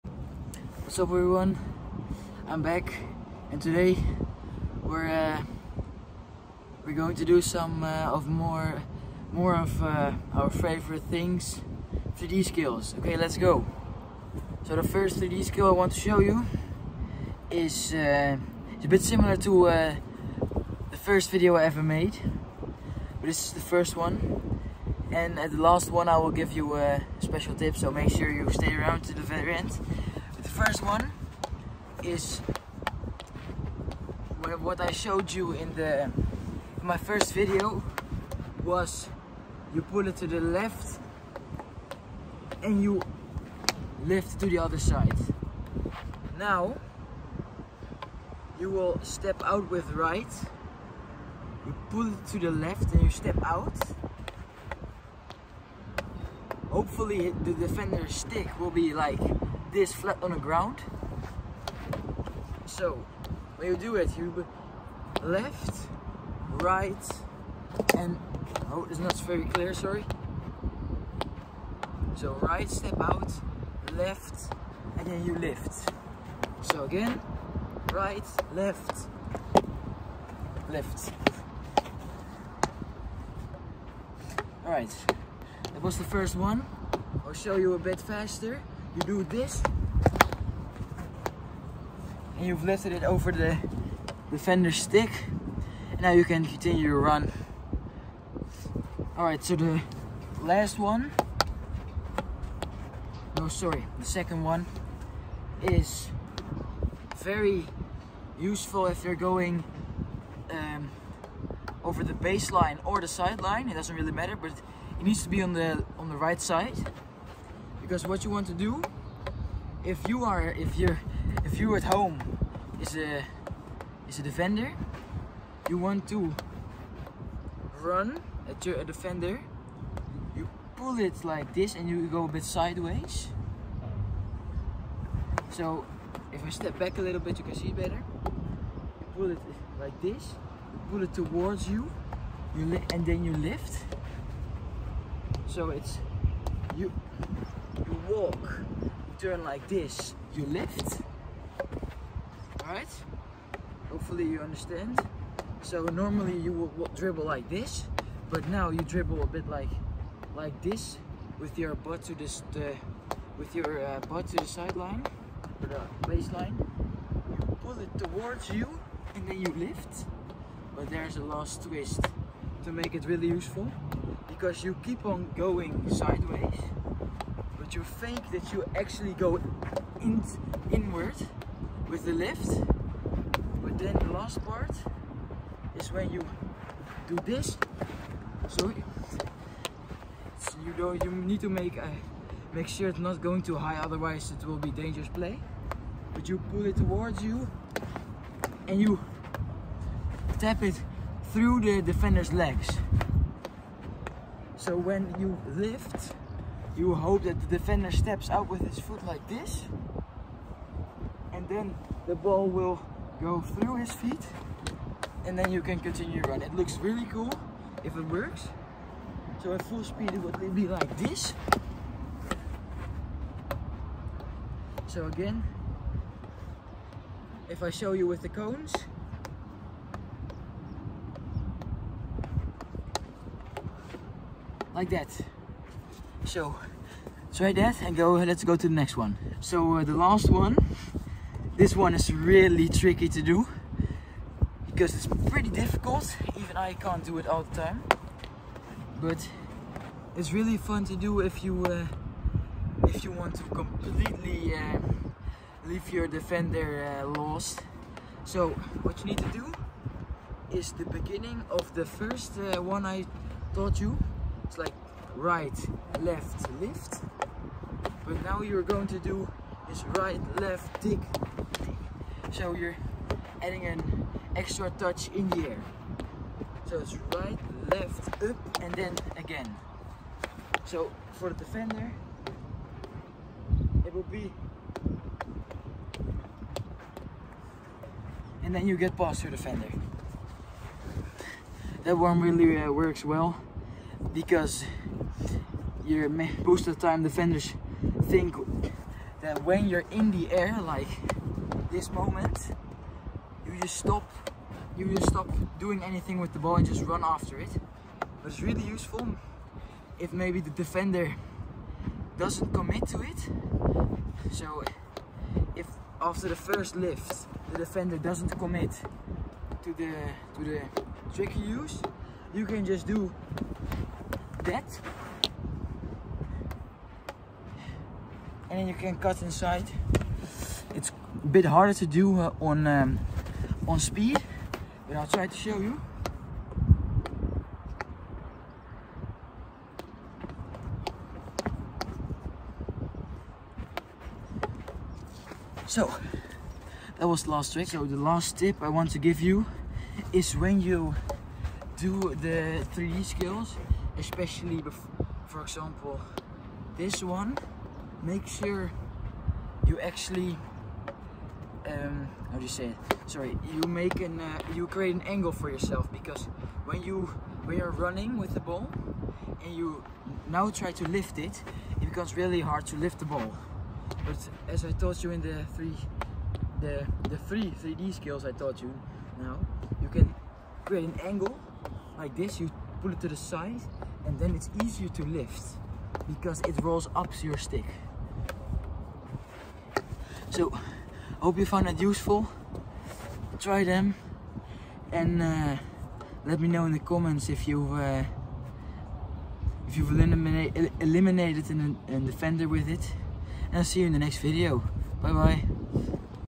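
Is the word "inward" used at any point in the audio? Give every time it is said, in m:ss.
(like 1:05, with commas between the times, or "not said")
3:00.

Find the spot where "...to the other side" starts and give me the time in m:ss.
0:44.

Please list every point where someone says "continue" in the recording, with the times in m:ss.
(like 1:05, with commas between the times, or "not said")
1:36, 3:35.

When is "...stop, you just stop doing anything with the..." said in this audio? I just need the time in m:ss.
5:03.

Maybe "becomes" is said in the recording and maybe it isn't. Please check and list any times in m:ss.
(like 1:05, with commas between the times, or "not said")
6:11.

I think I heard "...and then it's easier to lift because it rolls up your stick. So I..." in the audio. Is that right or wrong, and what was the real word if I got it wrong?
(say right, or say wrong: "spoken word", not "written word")
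right.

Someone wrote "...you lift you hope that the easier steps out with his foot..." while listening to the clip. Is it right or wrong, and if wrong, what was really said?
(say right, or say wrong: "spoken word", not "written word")
wrong: "defender", not "easier".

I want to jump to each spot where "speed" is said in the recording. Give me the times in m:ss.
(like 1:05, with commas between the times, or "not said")
3:39, 5:33.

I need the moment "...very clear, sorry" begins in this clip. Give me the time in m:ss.
1:09.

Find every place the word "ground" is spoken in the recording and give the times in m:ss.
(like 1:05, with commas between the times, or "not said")
1:00.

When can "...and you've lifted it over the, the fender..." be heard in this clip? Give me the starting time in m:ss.
1:32.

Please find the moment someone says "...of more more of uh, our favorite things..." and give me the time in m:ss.
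0:08.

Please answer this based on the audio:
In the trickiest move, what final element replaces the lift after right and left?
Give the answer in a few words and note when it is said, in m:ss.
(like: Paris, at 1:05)
Tick, at 4:30.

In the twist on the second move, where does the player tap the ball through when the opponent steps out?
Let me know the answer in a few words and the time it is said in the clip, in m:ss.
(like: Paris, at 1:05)
The defender's legs, at 3:21.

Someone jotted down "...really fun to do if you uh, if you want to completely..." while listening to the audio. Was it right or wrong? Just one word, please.
right.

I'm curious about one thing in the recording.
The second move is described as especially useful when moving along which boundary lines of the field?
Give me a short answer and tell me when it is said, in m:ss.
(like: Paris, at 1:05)
The baseline or the sideline, at 1:52.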